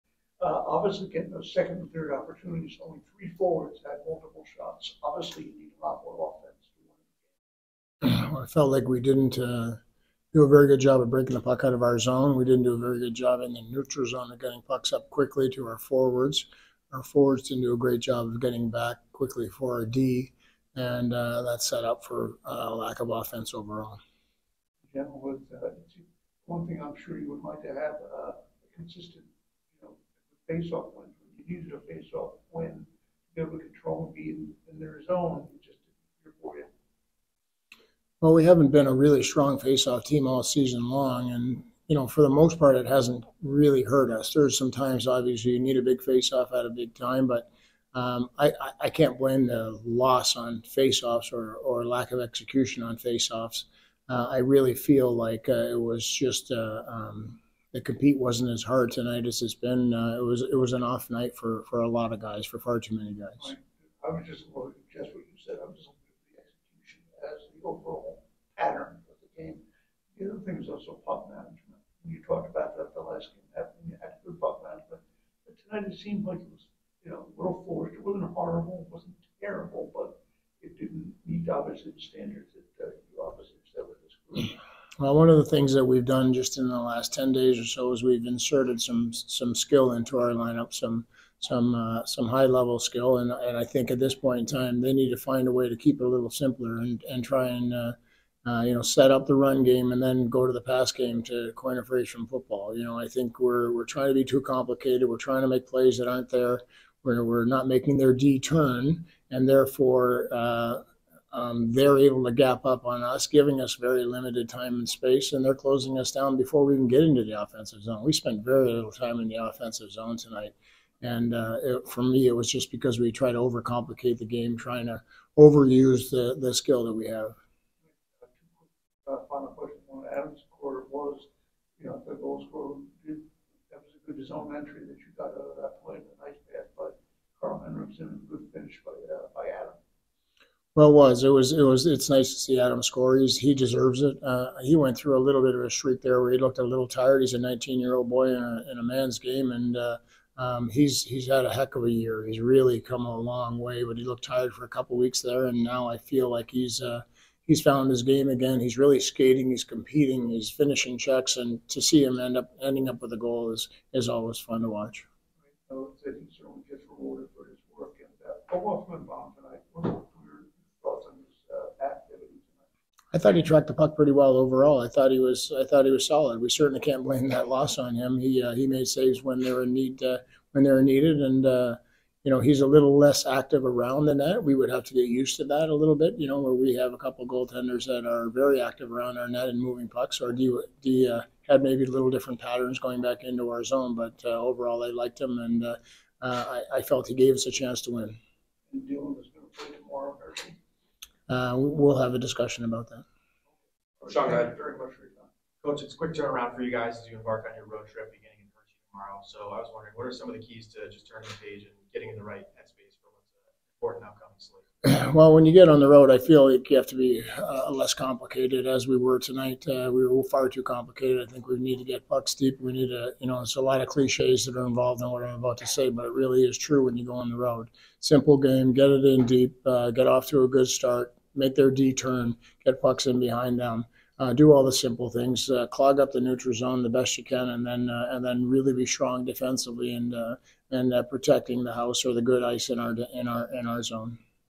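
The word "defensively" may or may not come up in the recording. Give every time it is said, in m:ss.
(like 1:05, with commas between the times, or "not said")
3:59.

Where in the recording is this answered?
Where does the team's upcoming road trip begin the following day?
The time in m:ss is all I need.
3:28.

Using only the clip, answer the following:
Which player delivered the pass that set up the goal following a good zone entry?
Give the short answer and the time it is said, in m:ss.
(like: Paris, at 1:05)
Karl Henriksson, at 2:17.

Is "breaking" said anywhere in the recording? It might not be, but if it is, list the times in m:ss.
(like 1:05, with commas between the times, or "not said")
0:11.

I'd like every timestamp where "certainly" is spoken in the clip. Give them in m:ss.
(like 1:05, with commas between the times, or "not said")
2:46, 2:56.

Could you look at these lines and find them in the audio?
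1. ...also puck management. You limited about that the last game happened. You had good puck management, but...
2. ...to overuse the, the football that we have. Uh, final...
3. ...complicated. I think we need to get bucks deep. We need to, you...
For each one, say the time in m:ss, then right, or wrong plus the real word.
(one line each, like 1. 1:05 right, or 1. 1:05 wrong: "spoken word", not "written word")
1. 1:10 wrong: "talked", not "limited"
2. 2:04 wrong: "skill", not "football"
3. 3:40 right.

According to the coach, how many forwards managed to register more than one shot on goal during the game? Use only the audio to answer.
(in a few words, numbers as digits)
3.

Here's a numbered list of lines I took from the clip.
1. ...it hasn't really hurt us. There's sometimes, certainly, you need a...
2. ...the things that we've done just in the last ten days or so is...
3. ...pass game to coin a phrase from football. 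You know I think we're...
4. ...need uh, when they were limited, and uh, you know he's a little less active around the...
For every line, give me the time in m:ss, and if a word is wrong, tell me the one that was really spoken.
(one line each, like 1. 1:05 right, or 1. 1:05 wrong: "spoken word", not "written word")
1. 0:42 wrong: "obviously", not "certainly"
2. 1:25 right
3. 1:40 right
4. 2:59 wrong: "needed", not "limited".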